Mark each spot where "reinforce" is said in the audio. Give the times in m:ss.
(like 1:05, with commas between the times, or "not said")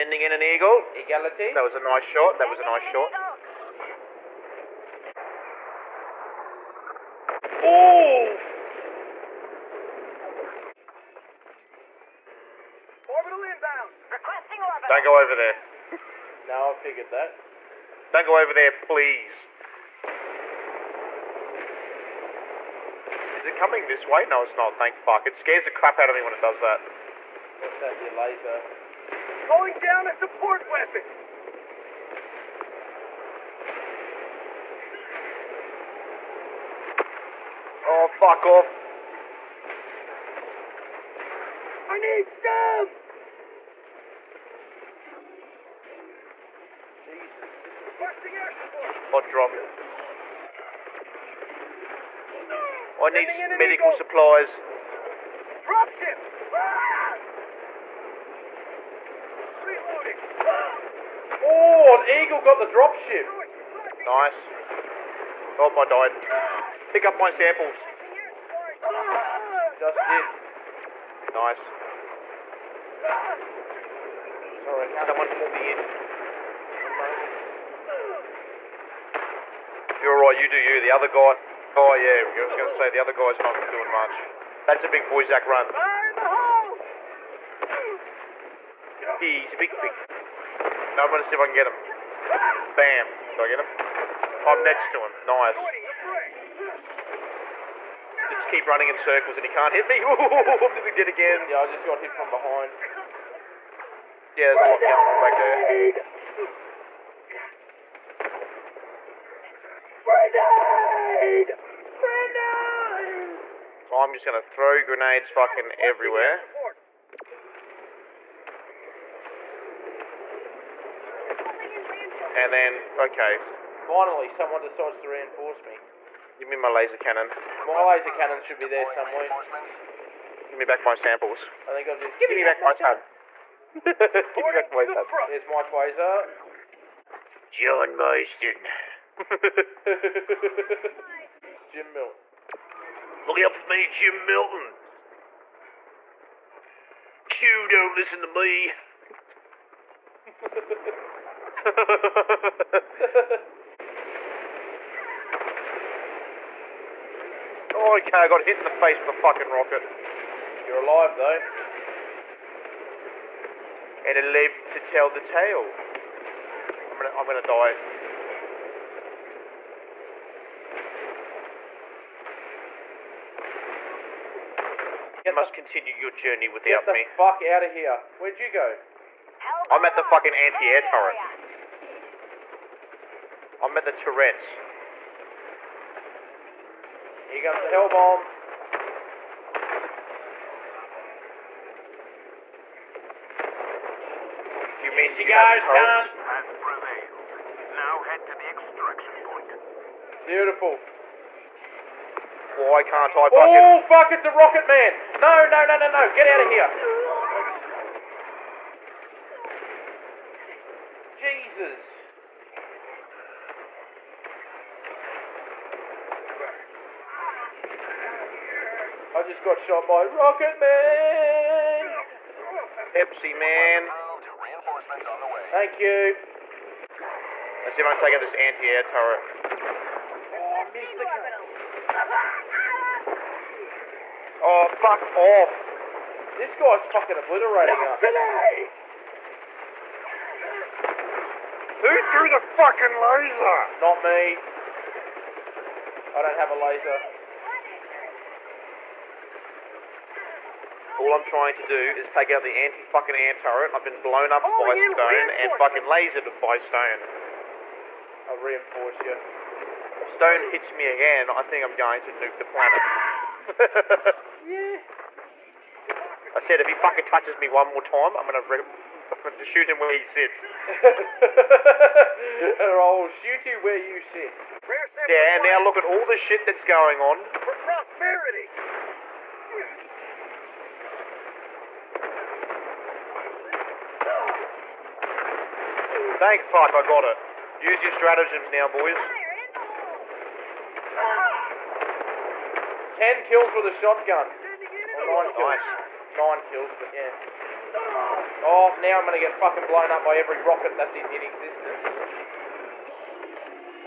2:05, 4:18.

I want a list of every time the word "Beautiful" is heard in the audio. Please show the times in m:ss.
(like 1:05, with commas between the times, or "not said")
3:20.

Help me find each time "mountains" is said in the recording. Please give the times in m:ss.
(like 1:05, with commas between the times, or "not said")
not said.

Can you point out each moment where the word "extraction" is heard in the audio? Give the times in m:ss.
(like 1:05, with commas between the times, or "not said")
3:18.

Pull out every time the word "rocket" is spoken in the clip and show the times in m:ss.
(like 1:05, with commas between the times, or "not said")
2:39, 3:24, 3:40, 5:00.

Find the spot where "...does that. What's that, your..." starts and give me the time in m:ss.
0:26.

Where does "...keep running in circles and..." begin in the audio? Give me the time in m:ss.
1:38.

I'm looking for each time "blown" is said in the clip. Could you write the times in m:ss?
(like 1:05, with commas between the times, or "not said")
4:14, 4:59.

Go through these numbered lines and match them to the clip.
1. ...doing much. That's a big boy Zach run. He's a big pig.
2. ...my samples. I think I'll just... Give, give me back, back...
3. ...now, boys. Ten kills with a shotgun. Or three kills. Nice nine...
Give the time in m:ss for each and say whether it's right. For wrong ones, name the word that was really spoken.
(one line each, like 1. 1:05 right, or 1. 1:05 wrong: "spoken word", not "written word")
1. 1:23 right
2. 2:10 right
3. 4:48 wrong: "nine", not "three".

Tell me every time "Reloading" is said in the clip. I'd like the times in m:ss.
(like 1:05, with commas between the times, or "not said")
0:59.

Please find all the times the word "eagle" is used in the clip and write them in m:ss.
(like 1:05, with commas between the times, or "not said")
0:00, 1:02.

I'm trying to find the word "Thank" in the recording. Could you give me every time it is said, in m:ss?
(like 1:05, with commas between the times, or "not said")
0:24, 3:45, 4:46.